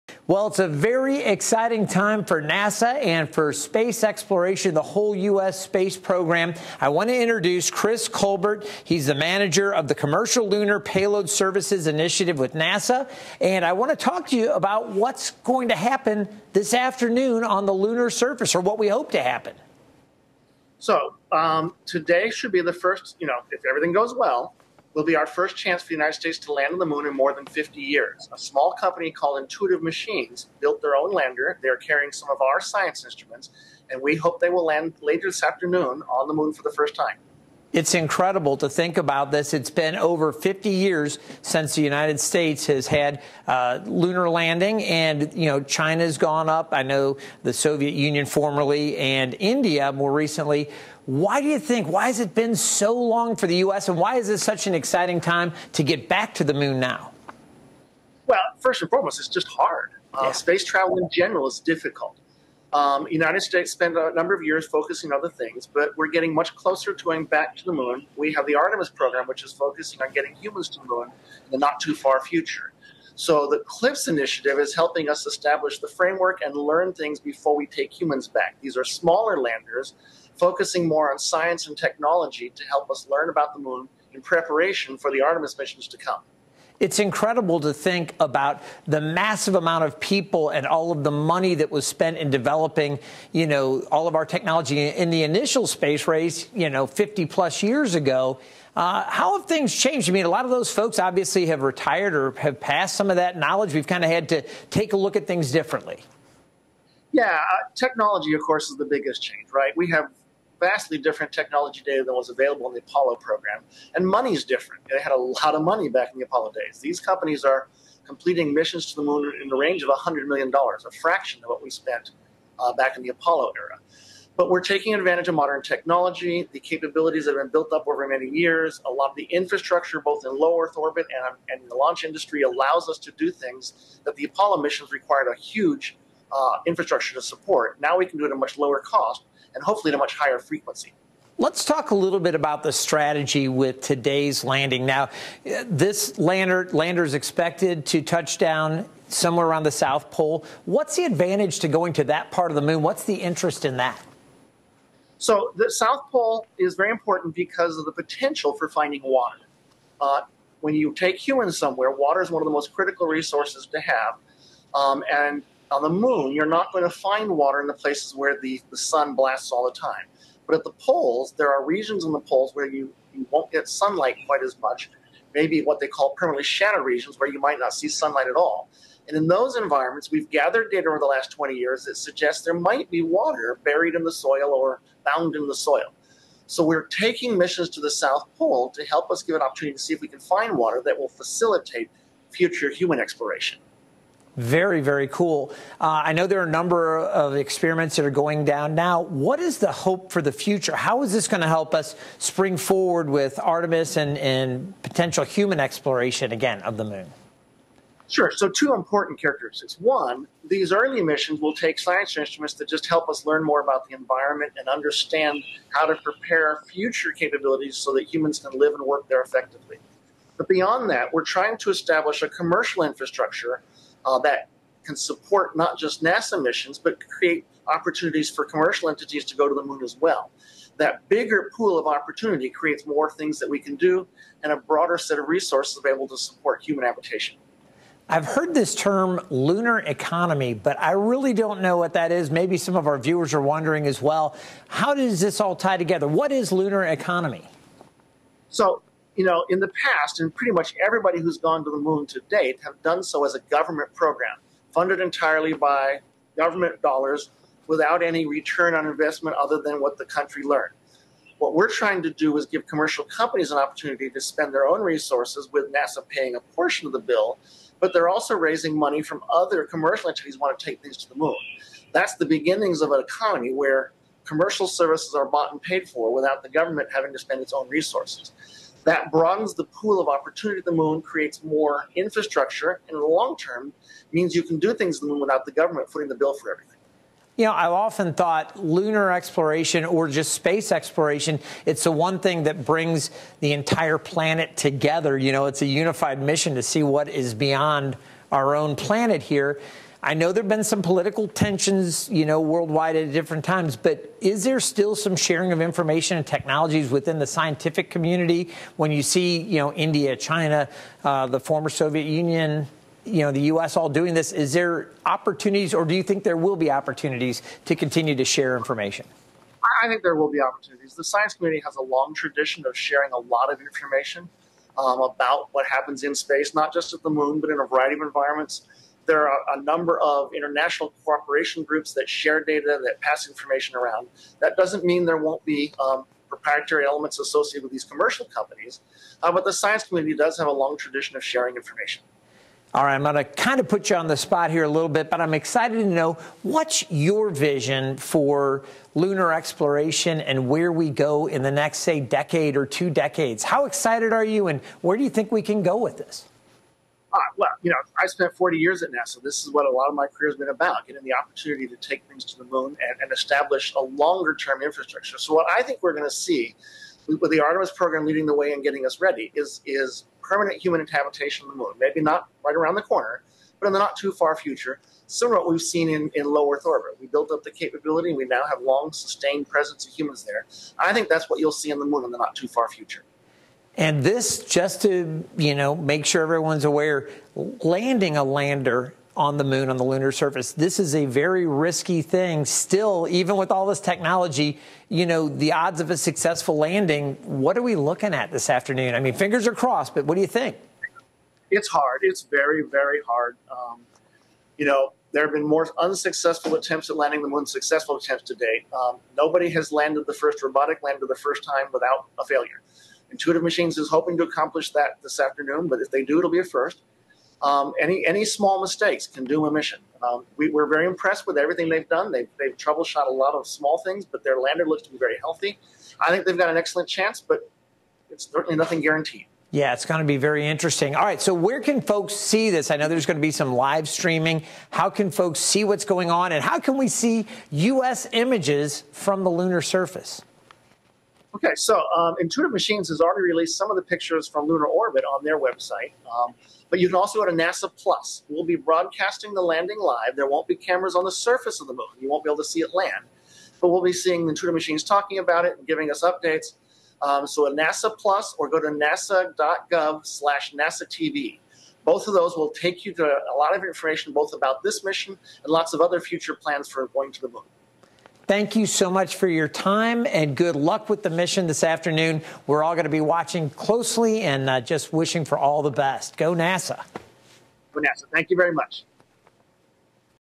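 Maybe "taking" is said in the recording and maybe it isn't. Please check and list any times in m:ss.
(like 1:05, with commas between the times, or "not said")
2:04, 3:06.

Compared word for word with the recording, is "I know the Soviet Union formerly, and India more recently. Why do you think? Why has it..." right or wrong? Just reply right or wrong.
right.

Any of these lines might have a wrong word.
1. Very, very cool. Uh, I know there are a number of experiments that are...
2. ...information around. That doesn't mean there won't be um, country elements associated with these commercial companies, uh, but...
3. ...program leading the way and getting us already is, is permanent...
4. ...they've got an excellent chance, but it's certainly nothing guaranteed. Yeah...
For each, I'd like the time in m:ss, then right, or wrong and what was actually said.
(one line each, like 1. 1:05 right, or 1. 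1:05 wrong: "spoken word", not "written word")
1. 3:14 right
2. 5:33 wrong: "proprietary", not "country"
3. 6:07 wrong: "ready", not "already"
4. 7:06 right.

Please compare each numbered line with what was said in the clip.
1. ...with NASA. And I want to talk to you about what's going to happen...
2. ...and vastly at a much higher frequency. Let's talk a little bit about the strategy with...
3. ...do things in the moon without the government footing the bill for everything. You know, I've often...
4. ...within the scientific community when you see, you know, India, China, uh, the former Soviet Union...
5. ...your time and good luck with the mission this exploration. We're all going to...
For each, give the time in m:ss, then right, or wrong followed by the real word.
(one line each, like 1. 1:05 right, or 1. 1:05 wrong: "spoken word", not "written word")
1. 0:12 right
2. 2:19 wrong: "hopefully", not "vastly"
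3. 4:44 right
4. 5:06 right
5. 7:49 wrong: "afternoon", not "exploration".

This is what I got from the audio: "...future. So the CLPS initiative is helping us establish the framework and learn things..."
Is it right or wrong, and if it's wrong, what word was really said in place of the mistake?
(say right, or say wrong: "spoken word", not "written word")
right.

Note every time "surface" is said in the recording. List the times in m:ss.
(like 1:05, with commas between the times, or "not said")
0:18, 6:30, 7:19, 7:31.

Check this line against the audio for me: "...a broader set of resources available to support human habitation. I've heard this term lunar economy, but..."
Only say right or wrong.
right.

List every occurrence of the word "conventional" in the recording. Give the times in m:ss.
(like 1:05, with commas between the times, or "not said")
not said.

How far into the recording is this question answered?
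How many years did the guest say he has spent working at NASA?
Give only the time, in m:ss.
5:58.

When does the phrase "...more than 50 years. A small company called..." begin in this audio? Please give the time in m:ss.
0:27.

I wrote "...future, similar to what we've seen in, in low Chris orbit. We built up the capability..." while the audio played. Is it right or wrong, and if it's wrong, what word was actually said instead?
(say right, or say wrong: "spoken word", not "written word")
wrong: "Earth", not "Chris".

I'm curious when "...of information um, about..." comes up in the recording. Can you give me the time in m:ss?
5:23.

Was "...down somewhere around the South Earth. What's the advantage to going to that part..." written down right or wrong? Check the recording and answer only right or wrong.
wrong.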